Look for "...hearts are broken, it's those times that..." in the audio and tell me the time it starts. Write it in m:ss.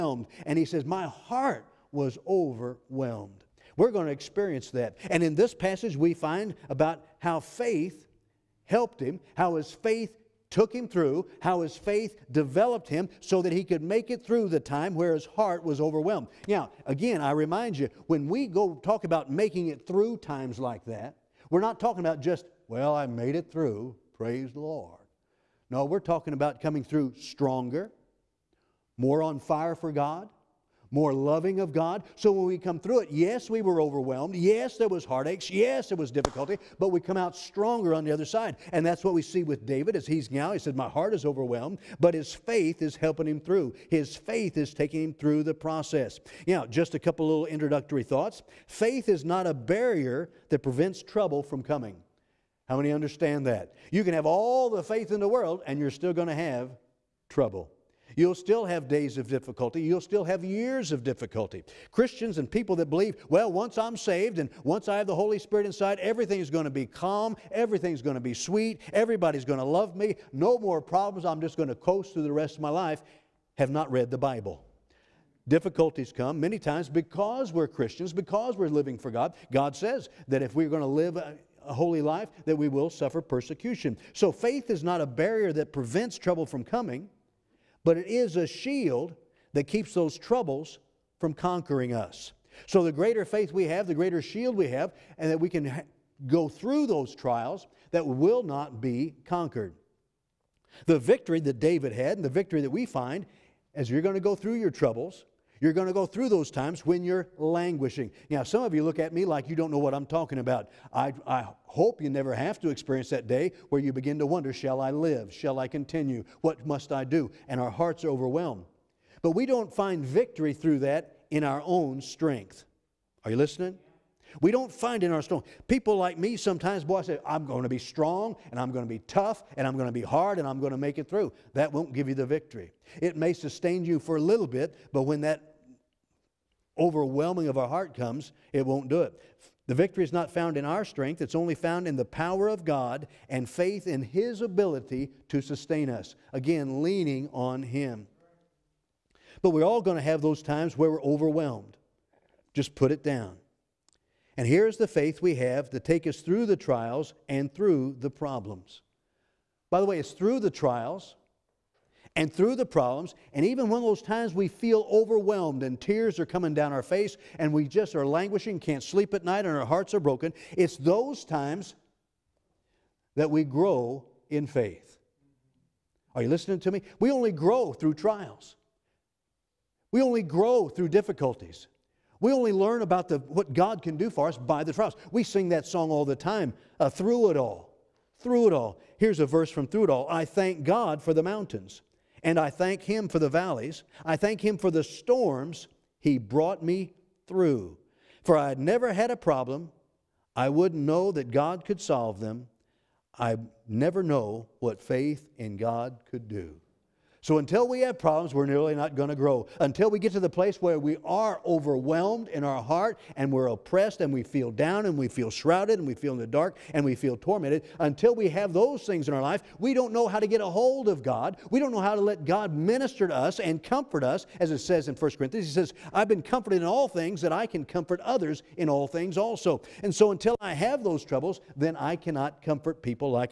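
2:49.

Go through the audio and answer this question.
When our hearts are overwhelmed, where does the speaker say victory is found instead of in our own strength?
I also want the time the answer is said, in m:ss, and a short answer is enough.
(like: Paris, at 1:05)
the power of God, at 2:22.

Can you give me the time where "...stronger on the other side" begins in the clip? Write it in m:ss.
0:37.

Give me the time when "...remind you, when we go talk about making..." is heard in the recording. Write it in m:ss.
0:17.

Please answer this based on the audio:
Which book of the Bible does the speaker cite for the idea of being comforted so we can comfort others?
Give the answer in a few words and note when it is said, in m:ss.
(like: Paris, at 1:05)
1 Corinthians, at 3:44.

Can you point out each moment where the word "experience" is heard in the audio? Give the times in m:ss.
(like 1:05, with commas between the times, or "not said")
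0:04, 1:52.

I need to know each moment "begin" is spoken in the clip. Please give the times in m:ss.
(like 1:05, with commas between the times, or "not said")
1:53.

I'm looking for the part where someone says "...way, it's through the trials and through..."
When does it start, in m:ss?
2:39.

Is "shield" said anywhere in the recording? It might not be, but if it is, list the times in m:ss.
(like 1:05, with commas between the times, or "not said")
1:28, 1:34.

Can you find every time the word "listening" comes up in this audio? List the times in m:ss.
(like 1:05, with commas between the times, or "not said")
2:03, 2:56.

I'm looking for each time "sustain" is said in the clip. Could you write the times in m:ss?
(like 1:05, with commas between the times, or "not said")
2:13, 2:25.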